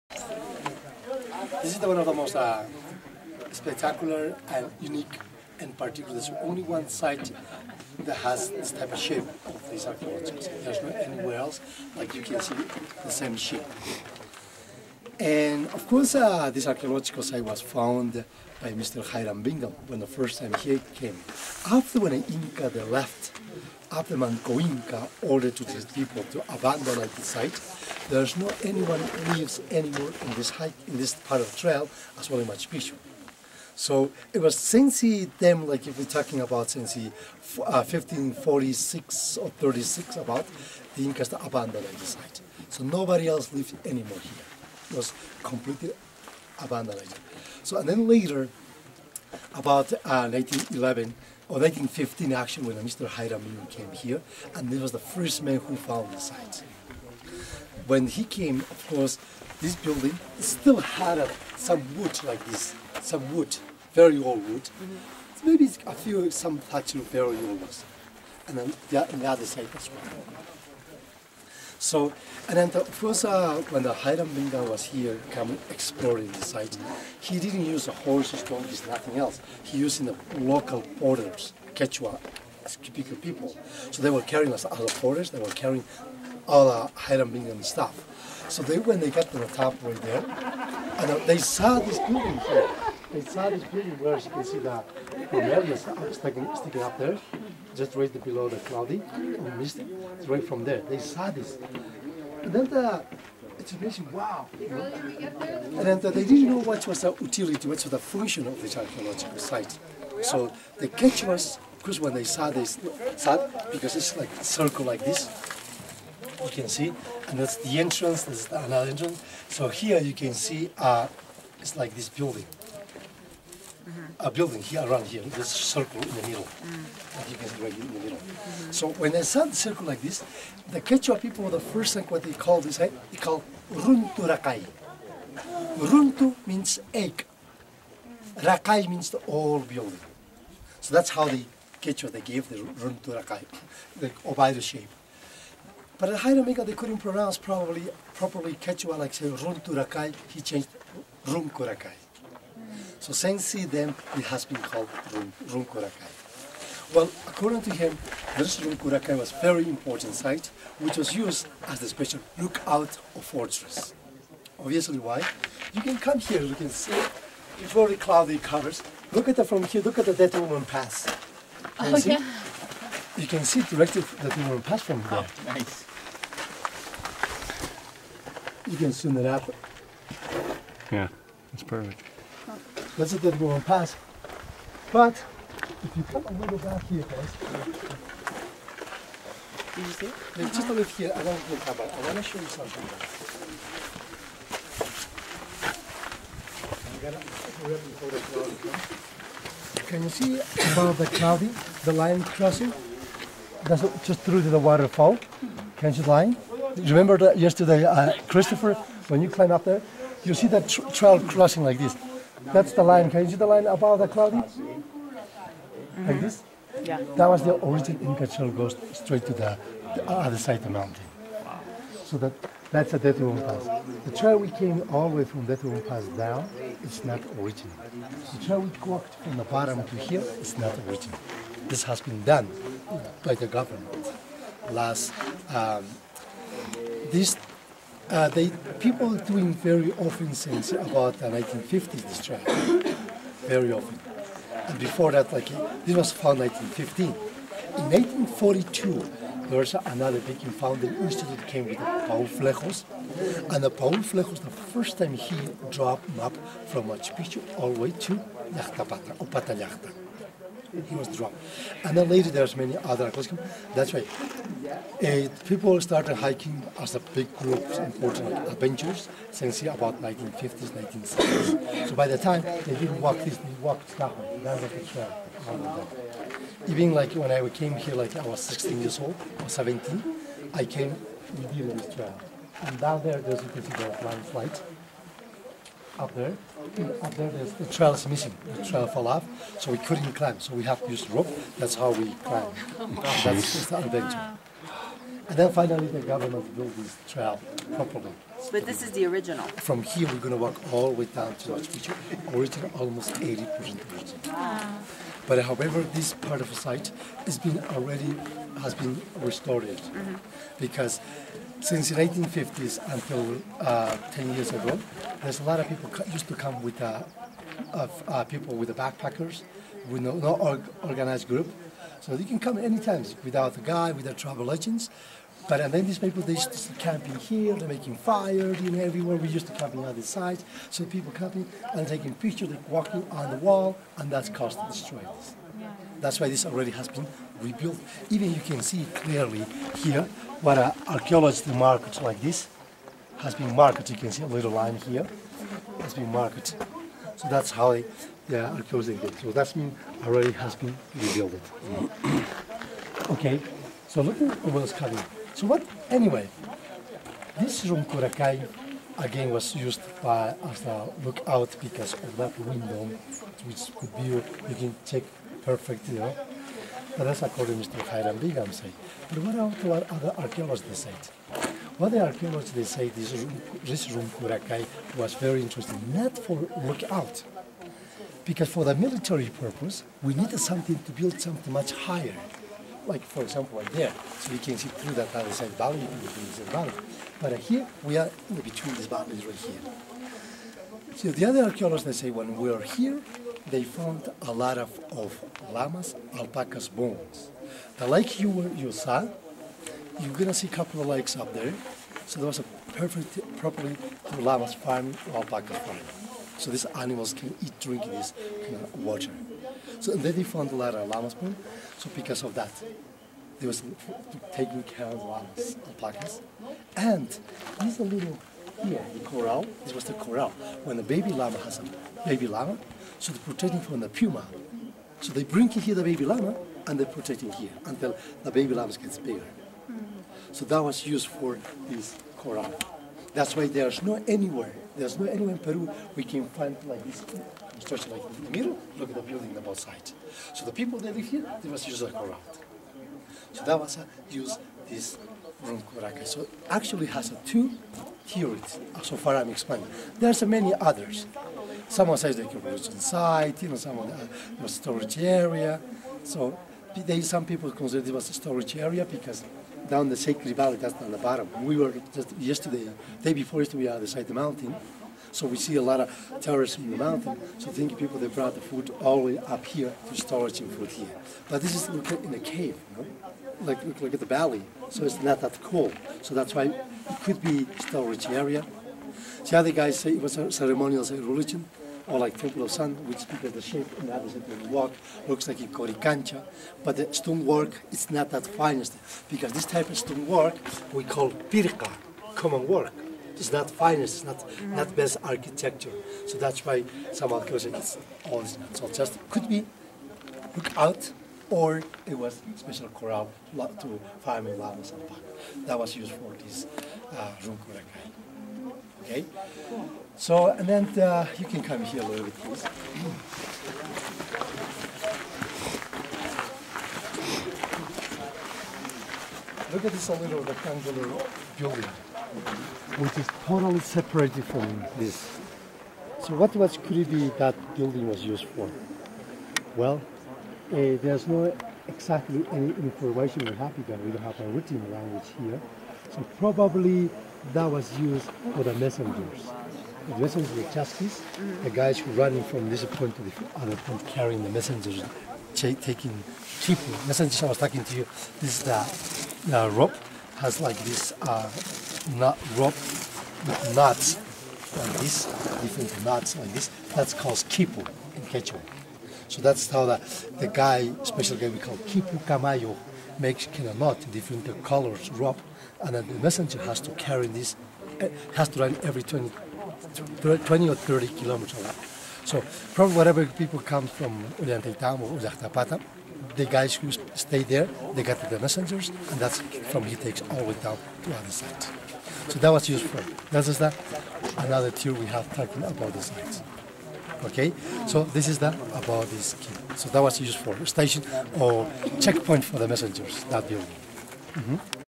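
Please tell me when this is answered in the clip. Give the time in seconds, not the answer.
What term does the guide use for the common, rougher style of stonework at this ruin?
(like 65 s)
490 s.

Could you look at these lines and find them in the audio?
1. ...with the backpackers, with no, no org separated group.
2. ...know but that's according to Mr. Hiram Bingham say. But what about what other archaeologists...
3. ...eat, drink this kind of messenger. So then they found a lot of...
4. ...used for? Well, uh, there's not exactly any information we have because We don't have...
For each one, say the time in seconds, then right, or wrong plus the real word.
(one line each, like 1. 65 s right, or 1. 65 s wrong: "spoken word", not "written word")
1. 318 s wrong: "organized", not "separated"
2. 365 s right
3. 407 s wrong: "water", not "messenger"
4. 528 s right.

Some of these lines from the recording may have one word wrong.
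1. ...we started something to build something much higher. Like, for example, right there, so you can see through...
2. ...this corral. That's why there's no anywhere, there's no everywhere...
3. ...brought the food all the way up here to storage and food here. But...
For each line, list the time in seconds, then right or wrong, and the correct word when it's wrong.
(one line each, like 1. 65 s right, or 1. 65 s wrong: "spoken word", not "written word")
1. 380 s wrong: "needed", not "started"
2. 431 s wrong: "anywhere", not "everywhere"
3. 468 s right.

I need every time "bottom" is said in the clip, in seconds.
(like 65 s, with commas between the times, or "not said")
229 s, 460 s.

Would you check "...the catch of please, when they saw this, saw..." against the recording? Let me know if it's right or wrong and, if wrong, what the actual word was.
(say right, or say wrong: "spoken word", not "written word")
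wrong: "course", not "please".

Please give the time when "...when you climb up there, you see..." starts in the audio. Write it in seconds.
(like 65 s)
209 s.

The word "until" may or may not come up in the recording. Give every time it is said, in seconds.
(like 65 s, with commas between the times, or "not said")
312 s, 427 s.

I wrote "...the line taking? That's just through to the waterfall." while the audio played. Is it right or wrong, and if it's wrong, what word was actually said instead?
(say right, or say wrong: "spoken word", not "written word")
wrong: "crossing", not "taking".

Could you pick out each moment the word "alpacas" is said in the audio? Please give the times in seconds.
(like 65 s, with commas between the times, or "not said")
396 s, 405 s, 415 s.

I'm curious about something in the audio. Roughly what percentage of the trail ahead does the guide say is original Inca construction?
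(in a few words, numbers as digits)
80%.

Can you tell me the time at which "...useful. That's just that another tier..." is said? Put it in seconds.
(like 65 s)
582 s.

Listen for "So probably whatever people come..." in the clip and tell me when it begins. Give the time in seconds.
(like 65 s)
572 s.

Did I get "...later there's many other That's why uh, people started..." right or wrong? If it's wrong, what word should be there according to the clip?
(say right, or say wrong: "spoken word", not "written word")
right.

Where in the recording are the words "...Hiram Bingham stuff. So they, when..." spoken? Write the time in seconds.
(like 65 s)
86 s.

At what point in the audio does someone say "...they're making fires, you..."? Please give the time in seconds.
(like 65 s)
327 s.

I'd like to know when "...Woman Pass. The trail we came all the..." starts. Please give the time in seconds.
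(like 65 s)
223 s.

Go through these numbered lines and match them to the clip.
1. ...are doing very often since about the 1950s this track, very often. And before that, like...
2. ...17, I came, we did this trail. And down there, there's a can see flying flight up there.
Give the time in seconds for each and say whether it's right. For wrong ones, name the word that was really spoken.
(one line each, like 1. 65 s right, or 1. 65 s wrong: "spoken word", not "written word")
1. 239 s right
2. 279 s right.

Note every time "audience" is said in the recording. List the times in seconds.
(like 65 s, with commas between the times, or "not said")
not said.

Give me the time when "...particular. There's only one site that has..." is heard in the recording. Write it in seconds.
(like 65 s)
5 s.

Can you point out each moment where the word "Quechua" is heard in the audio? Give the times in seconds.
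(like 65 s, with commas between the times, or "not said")
81 s, 130 s, 141 s, 148 s, 558 s.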